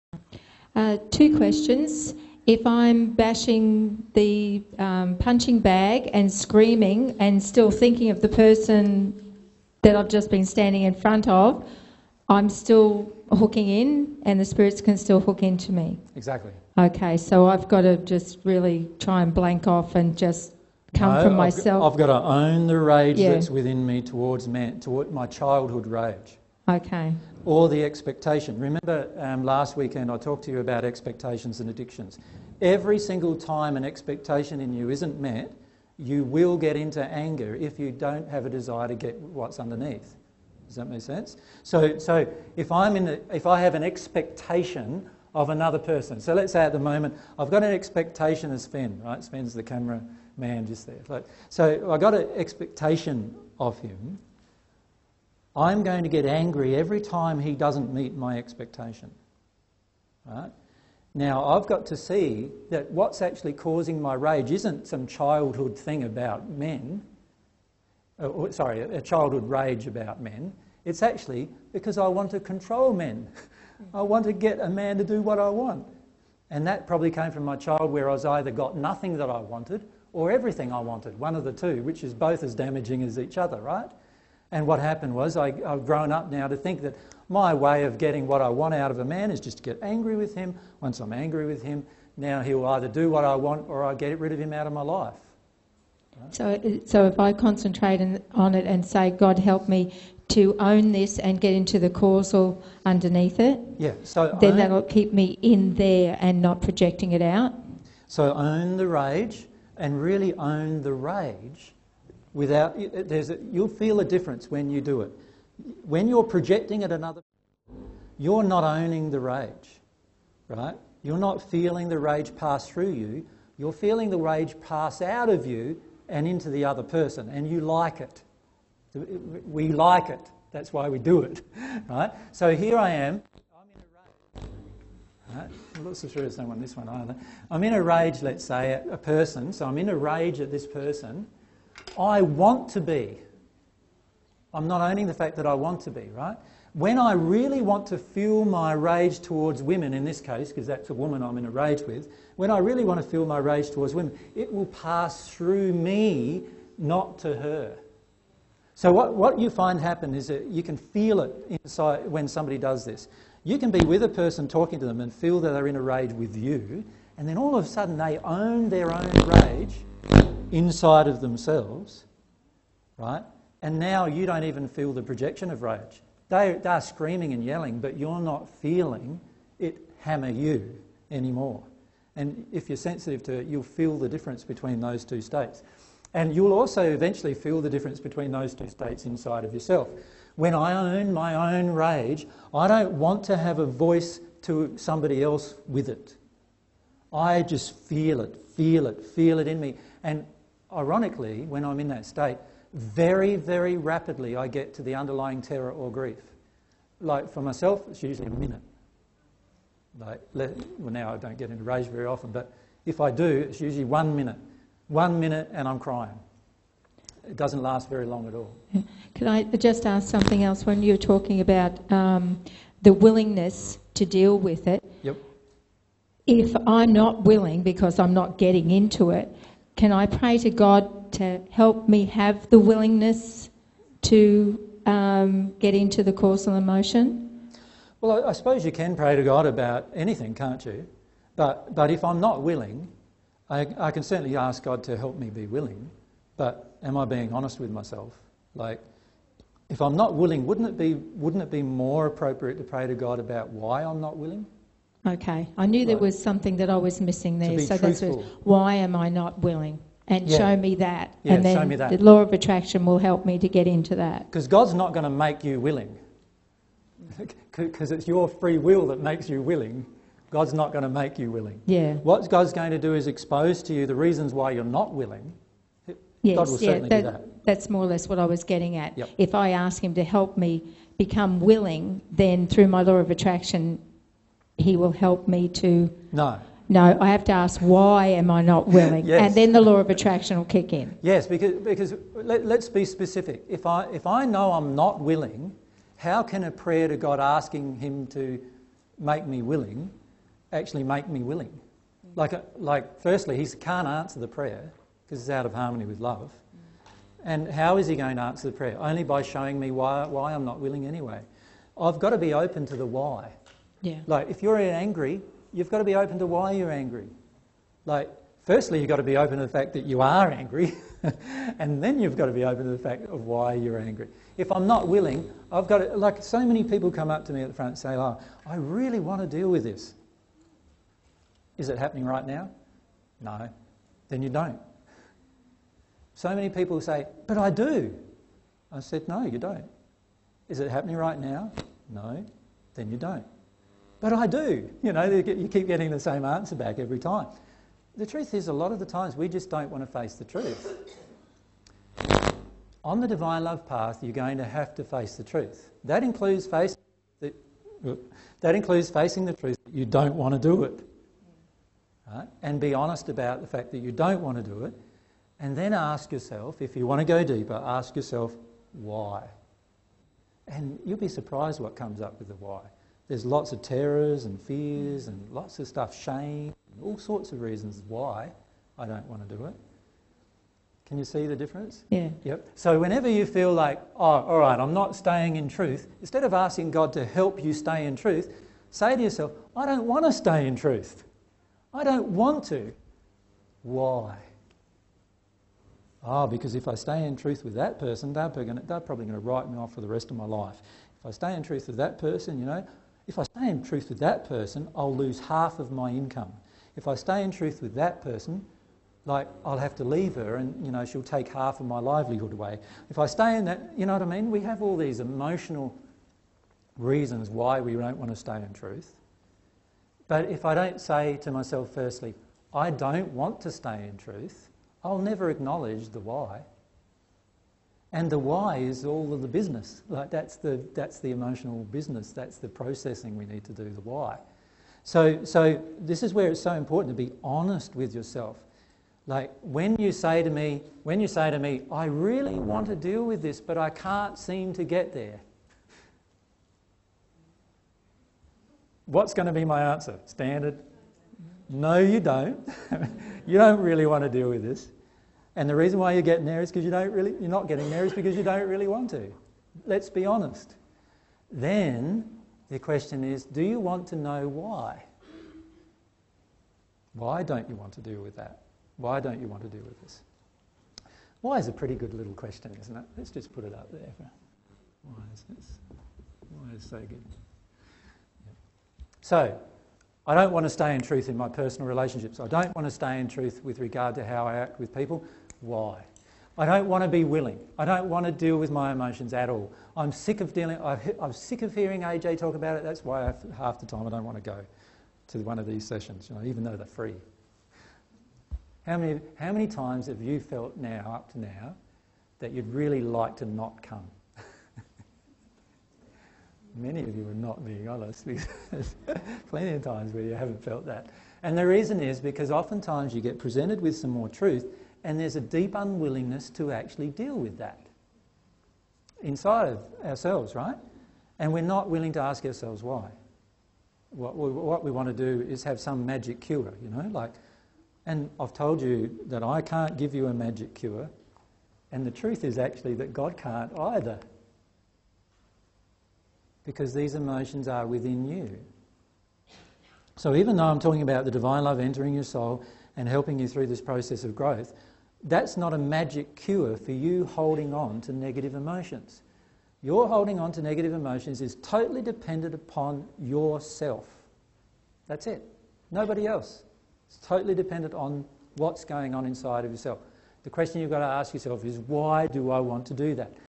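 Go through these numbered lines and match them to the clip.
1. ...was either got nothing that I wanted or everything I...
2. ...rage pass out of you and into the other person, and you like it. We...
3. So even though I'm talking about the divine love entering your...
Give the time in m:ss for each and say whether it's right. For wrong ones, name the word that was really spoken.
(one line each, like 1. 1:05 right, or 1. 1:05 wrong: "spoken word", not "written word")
1. 1:18 right
2. 2:04 right
3. 8:59 right.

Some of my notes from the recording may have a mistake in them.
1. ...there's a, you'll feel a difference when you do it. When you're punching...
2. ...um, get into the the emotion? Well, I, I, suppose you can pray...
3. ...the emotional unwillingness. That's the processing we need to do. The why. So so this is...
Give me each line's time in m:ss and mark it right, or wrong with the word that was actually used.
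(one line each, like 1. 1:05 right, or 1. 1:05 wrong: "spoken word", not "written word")
1. 1:53 wrong: "projecting", not "punching"
2. 3:54 right
3. 7:10 wrong: "business", not "unwillingness".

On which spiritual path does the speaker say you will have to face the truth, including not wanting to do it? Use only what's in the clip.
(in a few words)
divine love path.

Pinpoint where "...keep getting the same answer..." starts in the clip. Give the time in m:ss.
5:45.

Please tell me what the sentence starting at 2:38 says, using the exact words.
So, what, what you find happen is that you can feel it inside when somebody does this.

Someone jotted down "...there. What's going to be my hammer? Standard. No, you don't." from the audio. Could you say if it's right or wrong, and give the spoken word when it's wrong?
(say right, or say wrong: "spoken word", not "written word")
wrong: "answer", not "hammer".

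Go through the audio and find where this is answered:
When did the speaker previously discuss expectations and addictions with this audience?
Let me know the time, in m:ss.
0:29.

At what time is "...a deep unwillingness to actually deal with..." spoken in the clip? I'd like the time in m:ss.
8:35.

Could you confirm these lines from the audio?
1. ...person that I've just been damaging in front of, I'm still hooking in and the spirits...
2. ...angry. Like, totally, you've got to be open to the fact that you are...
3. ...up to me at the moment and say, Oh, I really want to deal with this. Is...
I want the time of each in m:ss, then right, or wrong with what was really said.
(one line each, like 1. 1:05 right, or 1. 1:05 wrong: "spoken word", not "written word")
1. 0:08 wrong: "standing", not "damaging"
2. 5:16 wrong: "firstly", not "totally"
3. 5:27 wrong: "front", not "moment".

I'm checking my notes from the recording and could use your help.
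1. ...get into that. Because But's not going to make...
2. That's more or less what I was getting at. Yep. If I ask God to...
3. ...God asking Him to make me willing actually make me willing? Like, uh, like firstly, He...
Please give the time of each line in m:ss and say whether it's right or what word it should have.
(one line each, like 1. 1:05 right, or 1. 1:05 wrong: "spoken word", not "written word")
1. 4:23 wrong: "God", not "But"
2. 4:37 wrong: "Him", not "God"
3. 4:56 right.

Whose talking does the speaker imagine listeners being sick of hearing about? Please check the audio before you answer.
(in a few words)
AJ.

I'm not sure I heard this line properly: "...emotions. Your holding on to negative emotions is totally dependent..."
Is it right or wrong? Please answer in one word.
right.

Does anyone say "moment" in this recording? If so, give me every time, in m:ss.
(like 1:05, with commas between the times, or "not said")
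0:46.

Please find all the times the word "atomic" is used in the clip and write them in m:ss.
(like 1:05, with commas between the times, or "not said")
not said.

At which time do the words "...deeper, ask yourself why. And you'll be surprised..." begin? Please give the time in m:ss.
6:07.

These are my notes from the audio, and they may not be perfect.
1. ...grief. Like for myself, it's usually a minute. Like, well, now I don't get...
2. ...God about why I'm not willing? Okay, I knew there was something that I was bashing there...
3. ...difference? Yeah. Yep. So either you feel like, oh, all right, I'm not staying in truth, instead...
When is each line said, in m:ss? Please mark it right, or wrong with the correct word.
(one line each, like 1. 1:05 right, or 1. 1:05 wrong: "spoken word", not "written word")
1. 3:25 right
2. 4:12 wrong: "missing", not "bashing"
3. 6:21 wrong: "whenever", not "either".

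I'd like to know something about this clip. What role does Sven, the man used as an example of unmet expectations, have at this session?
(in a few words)
camera man.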